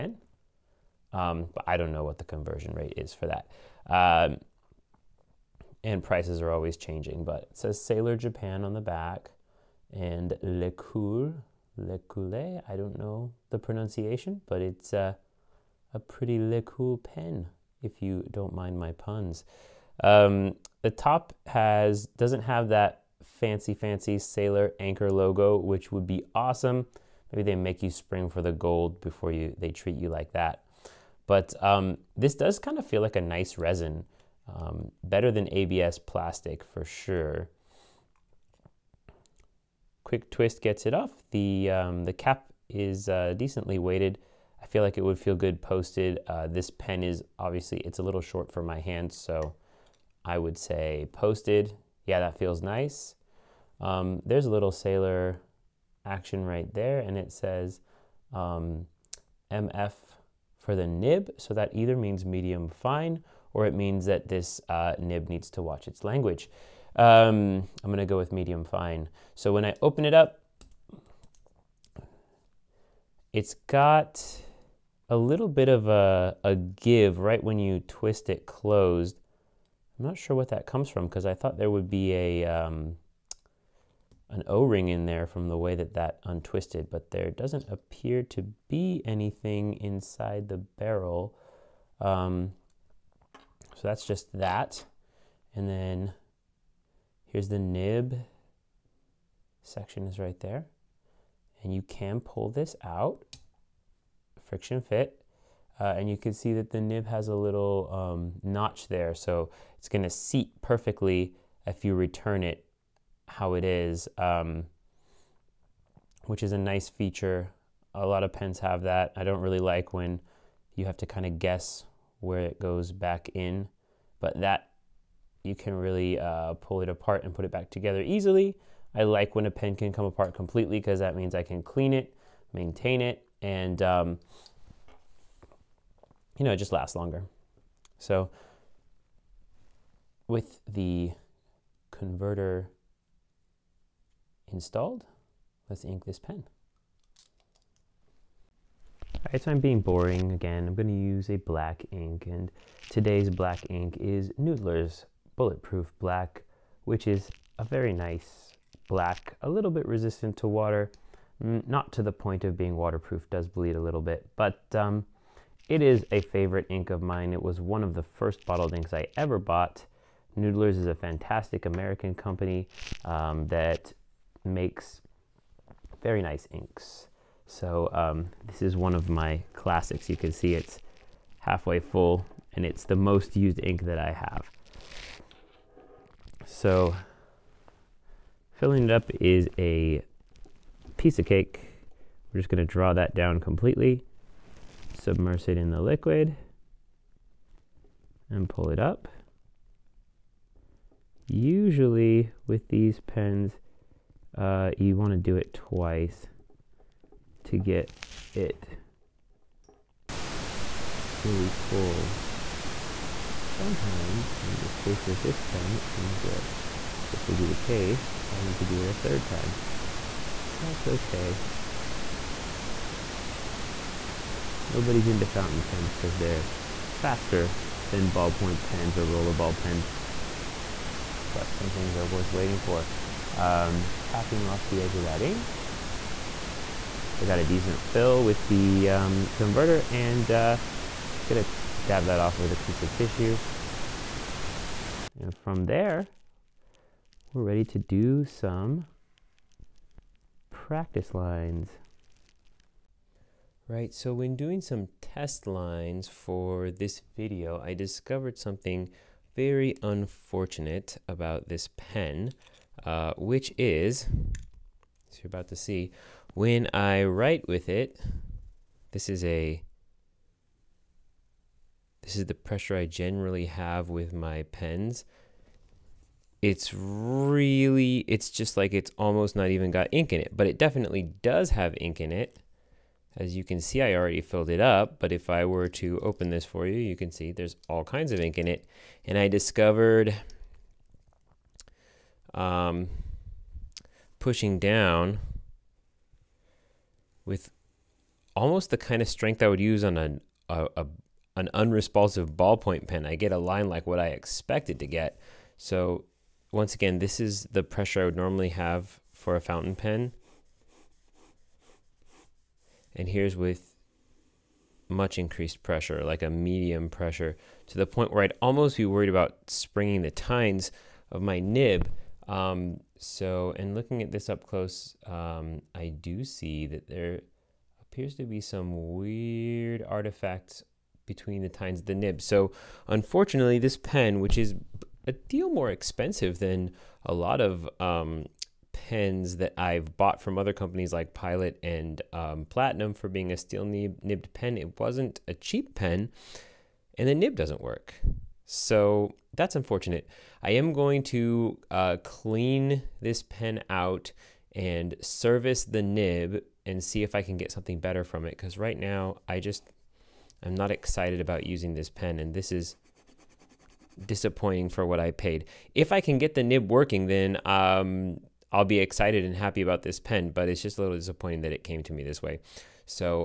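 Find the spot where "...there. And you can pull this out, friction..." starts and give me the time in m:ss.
1:40.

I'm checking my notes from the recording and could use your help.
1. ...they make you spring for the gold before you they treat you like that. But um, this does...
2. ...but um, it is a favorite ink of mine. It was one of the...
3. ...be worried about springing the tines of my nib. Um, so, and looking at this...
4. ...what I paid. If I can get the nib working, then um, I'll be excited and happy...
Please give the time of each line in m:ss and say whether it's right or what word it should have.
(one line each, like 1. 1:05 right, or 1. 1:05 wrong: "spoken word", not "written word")
1. 0:27 right
2. 2:44 right
3. 5:18 right
4. 6:04 right.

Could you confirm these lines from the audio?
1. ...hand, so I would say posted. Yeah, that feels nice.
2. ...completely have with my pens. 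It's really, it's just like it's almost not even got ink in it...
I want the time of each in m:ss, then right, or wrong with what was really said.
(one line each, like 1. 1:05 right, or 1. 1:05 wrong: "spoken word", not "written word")
1. 0:48 right
2. 4:32 wrong: "generally", not "completely".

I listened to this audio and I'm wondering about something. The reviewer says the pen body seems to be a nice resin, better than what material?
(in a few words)
ABS plastic.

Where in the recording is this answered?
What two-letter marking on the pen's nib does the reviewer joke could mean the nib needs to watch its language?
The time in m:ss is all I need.
0:59.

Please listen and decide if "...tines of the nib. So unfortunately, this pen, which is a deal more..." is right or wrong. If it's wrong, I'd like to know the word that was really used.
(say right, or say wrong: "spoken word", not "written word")
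right.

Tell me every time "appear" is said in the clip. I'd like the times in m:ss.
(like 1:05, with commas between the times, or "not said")
1:27, 5:27.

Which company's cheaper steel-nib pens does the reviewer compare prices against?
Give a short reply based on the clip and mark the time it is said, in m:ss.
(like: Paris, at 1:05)
Pilot, at 5:41.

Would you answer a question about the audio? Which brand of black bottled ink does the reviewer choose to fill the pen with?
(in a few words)
Noodler's Bulletproof Black.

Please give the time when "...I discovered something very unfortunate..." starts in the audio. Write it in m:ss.
4:17.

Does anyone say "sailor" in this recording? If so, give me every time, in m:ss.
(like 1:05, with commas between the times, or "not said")
0:07, 0:24, 0:54.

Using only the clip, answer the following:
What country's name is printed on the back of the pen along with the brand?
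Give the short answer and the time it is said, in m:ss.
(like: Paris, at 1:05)
Japan, at 0:08.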